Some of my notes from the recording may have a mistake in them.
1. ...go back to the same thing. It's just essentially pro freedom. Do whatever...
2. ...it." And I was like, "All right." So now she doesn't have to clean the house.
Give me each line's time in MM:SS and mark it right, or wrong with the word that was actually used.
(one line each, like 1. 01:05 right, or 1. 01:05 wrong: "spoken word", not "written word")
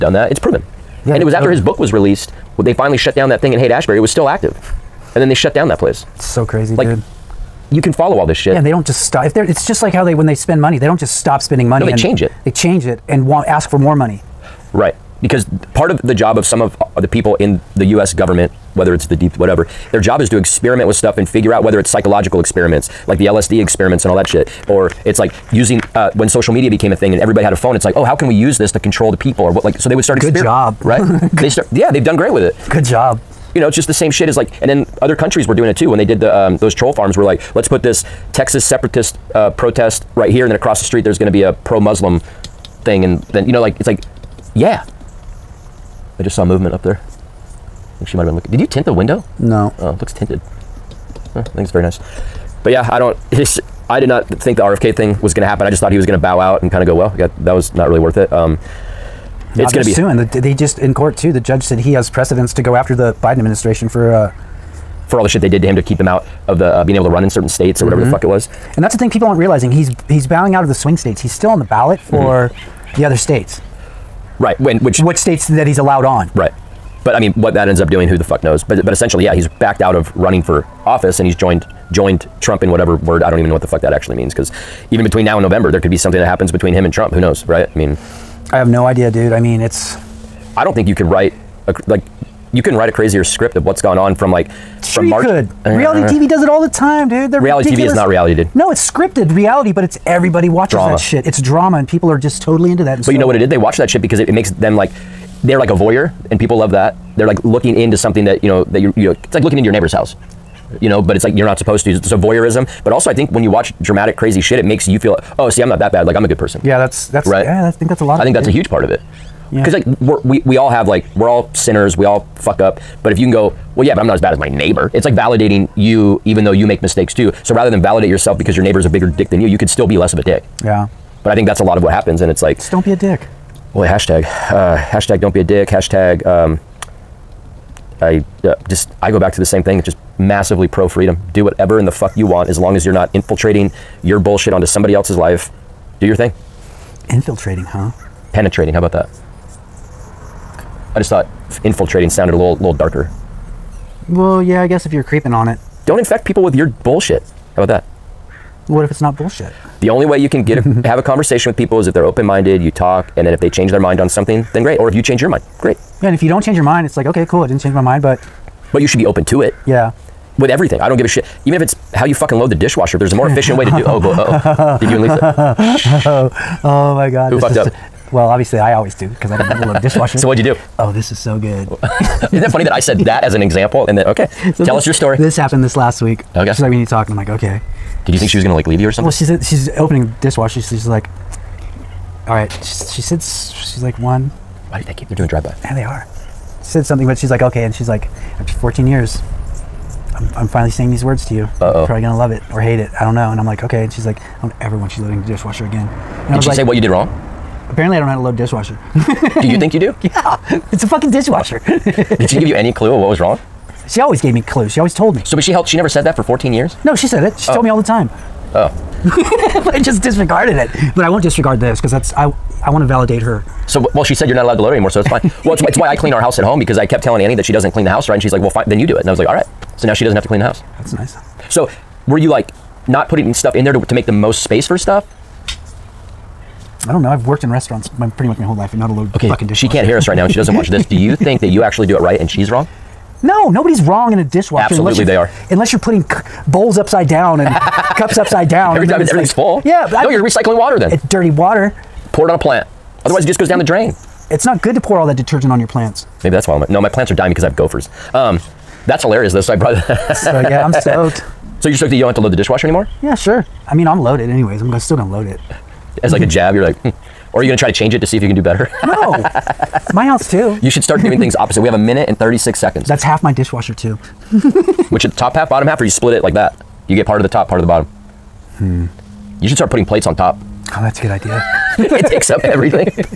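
1. 02:19 wrong: "massively", not "essentially"
2. 03:48 right.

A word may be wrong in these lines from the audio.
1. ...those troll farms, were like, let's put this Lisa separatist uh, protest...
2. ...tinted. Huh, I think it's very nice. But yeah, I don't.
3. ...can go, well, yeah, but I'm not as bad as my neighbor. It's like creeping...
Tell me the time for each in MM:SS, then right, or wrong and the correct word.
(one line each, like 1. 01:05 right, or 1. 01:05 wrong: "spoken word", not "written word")
1. 00:36 wrong: "Texas", not "Lisa"
2. 00:50 right
3. 02:03 wrong: "validating", not "creeping".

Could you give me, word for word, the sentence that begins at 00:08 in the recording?
Yeah, and they don't just stop.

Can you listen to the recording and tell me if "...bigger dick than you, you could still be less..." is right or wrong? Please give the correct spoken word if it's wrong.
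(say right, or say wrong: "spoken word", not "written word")
right.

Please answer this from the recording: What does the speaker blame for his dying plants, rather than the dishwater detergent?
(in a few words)
Gophers.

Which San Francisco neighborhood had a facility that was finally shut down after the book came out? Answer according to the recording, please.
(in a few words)
Haight Ashbury.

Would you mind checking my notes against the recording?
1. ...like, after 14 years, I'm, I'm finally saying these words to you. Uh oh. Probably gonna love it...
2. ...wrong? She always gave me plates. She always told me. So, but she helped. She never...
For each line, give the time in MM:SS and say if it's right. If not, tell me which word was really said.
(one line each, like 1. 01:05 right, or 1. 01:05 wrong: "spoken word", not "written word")
1. 03:17 right
2. 03:33 wrong: "clues", not "plates".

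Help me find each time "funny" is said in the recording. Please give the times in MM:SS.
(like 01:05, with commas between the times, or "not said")
03:02.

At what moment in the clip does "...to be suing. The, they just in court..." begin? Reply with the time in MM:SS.
00:59.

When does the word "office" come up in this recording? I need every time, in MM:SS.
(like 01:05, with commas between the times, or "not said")
01:20.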